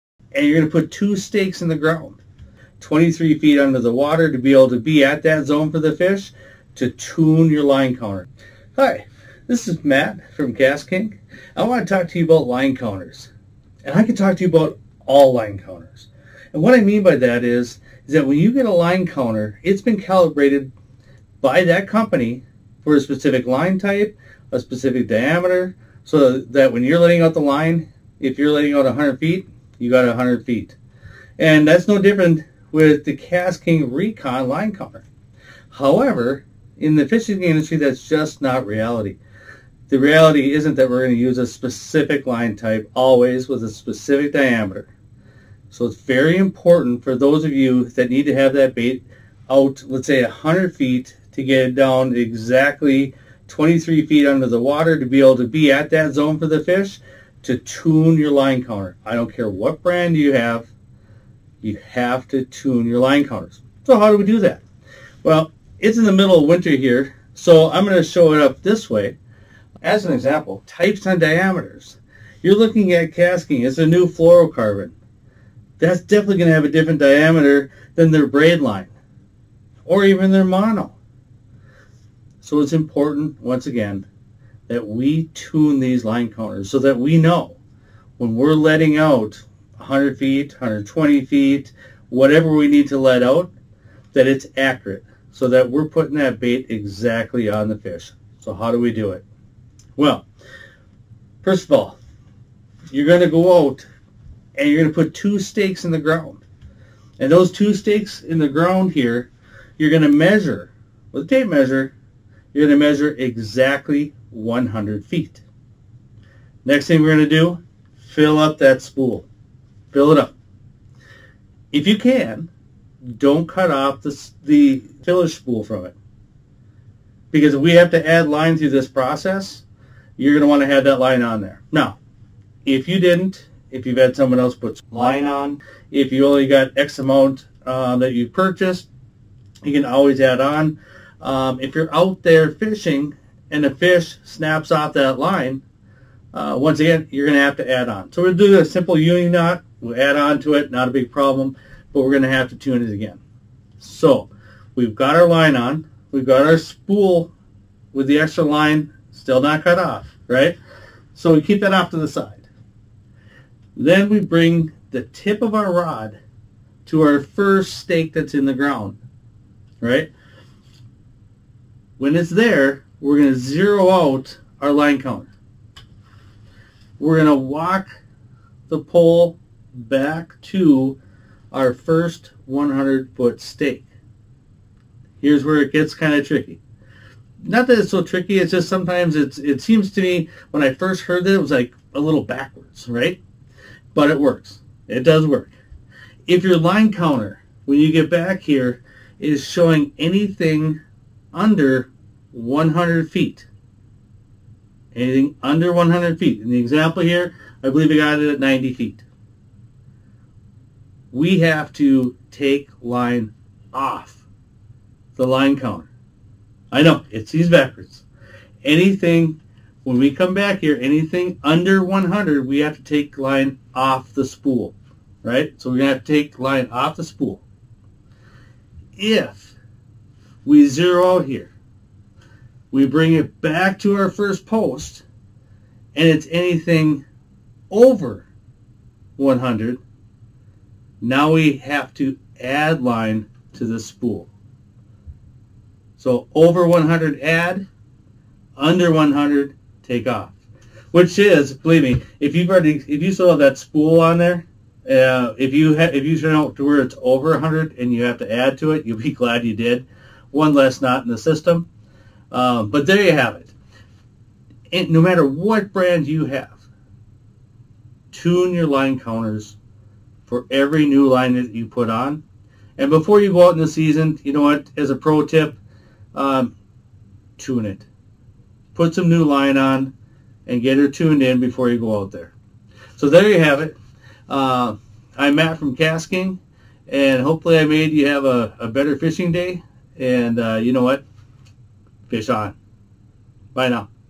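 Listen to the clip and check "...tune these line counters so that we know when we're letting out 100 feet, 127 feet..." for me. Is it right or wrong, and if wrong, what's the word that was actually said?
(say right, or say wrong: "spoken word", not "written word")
wrong: "120", not "127".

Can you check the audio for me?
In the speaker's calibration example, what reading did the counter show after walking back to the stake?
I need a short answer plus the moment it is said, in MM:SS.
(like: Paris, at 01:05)
90 feet, at 03:28.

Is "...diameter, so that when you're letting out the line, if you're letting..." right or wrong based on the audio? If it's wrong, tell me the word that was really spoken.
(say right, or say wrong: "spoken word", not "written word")
right.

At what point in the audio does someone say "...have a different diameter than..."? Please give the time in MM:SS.
01:16.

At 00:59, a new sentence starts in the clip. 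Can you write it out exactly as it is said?
I don't care what brand you have, you have to tune your line counters.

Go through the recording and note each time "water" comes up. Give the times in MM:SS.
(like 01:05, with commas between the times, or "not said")
00:03, 00:54.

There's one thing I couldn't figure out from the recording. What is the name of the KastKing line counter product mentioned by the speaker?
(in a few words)
ReKon.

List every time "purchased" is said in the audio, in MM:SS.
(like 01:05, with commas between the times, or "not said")
02:18.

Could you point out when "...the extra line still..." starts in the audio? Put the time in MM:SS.
02:38.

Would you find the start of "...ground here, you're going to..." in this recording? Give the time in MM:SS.
01:48.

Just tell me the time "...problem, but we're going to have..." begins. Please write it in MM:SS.
02:31.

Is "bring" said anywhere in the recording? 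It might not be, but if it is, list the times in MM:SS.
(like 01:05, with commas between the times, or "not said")
02:44, 03:52.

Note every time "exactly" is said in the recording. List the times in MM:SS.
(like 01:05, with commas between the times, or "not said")
00:52, 01:36, 01:53.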